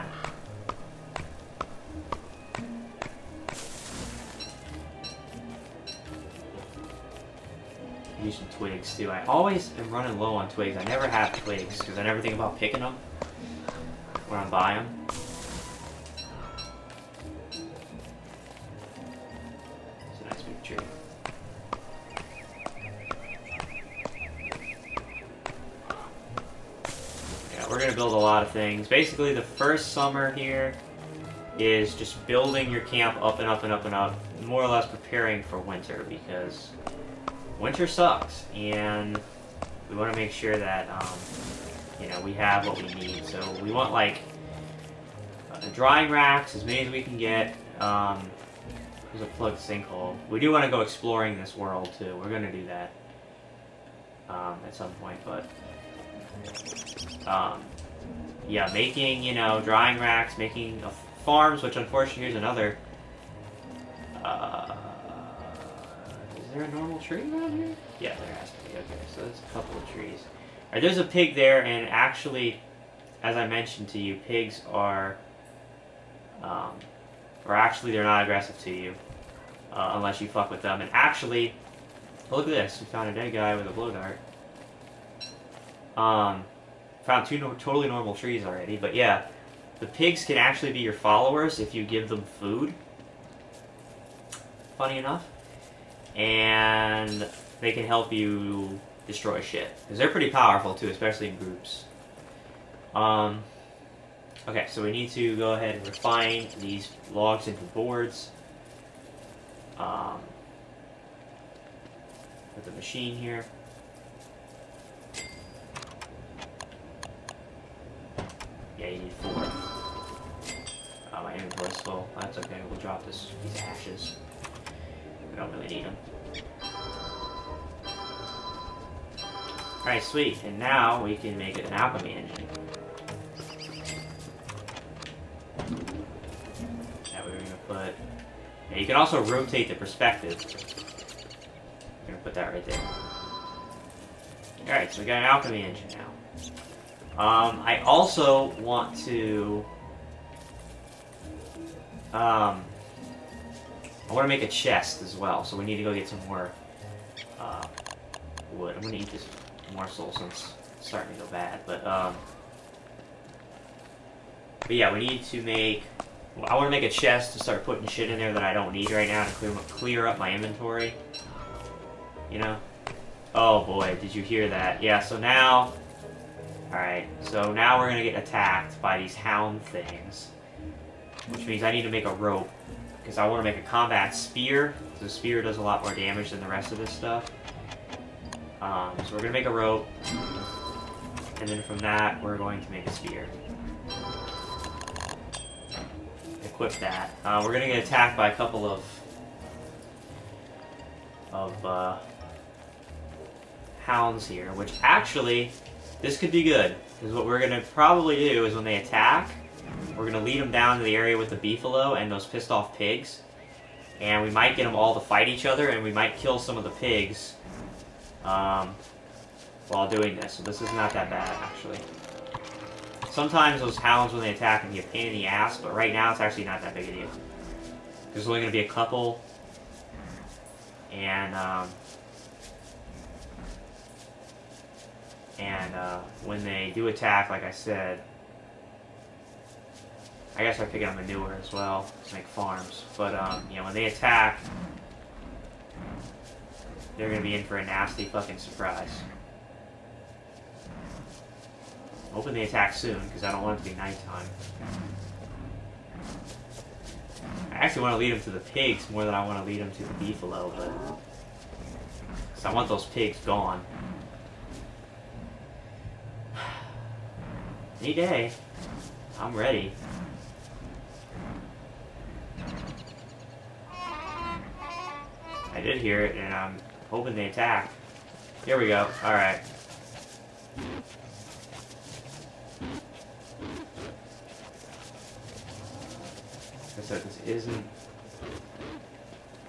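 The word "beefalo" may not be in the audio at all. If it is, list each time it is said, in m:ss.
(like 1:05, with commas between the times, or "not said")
3:31, 4:19.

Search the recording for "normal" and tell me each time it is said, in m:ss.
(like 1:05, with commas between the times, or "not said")
1:06, 1:27.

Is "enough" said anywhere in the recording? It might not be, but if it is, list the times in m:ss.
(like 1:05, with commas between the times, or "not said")
1:34.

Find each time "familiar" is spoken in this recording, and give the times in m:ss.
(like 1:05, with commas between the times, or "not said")
not said.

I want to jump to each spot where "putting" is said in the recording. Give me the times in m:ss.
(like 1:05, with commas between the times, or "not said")
2:47.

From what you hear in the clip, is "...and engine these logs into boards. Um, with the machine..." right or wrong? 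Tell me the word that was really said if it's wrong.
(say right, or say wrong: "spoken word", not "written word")
wrong: "refine", not "engine".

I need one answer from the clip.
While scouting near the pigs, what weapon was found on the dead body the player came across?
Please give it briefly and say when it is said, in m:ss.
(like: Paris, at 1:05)
Blow dart, at 1:23.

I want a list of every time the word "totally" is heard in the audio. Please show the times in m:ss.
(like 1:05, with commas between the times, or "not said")
1:27.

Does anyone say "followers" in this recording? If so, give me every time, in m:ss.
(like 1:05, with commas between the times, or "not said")
1:30.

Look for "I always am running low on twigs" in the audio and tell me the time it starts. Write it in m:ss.
0:09.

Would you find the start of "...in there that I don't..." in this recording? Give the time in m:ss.
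2:48.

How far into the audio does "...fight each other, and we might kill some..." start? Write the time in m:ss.
3:34.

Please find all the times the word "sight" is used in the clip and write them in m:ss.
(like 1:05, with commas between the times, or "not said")
not said.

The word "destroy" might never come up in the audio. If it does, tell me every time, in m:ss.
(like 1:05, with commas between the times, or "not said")
1:39.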